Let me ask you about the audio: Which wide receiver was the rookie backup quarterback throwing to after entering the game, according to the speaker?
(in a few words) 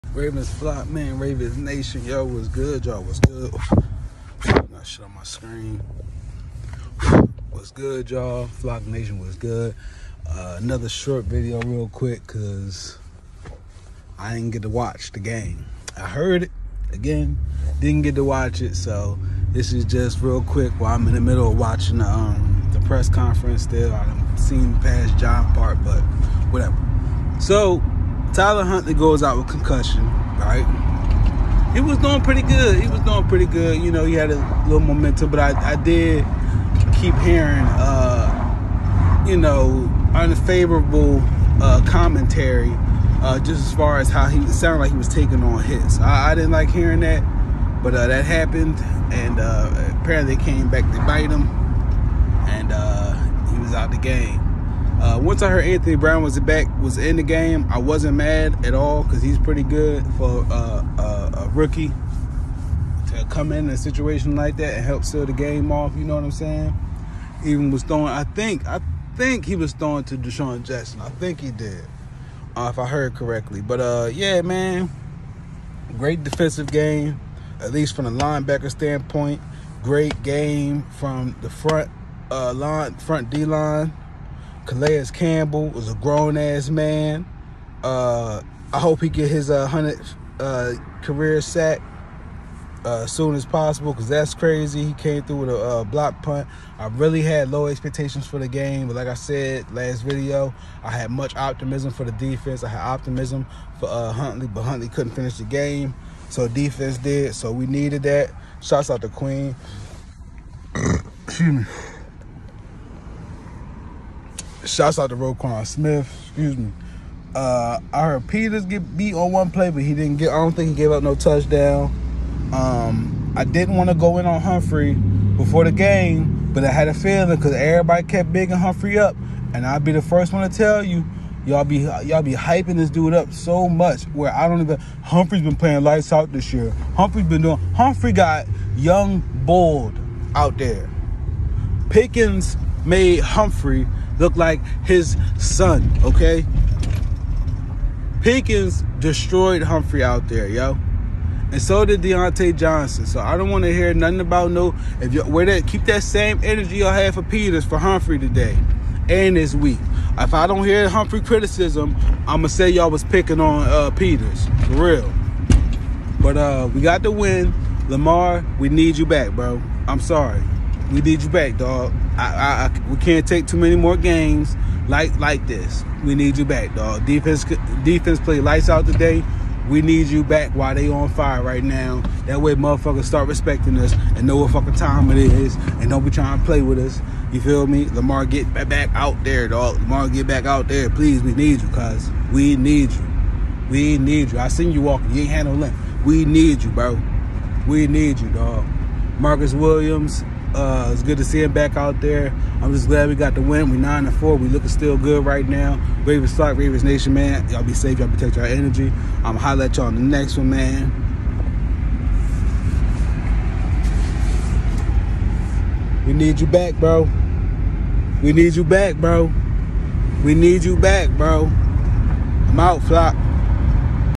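DeSean Jackson.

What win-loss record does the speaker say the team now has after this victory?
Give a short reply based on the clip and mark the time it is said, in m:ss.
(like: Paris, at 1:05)
9-4, at 3:23.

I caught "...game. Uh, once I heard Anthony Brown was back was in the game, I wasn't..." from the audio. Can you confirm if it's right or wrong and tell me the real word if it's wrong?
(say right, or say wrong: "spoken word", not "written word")
right.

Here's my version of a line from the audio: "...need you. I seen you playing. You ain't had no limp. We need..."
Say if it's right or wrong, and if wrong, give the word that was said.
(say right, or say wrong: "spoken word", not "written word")
wrong: "walking", not "playing".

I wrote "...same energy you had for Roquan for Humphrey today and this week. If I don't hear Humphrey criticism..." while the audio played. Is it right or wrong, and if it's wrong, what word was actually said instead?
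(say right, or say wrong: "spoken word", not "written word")
wrong: "Peters", not "Roquan".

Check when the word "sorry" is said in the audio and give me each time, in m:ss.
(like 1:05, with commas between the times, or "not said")
2:49.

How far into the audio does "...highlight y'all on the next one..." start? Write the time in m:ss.
3:29.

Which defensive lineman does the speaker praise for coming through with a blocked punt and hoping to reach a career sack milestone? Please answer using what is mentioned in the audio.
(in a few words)
Calais Campbell.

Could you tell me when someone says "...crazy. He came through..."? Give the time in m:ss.
1:34.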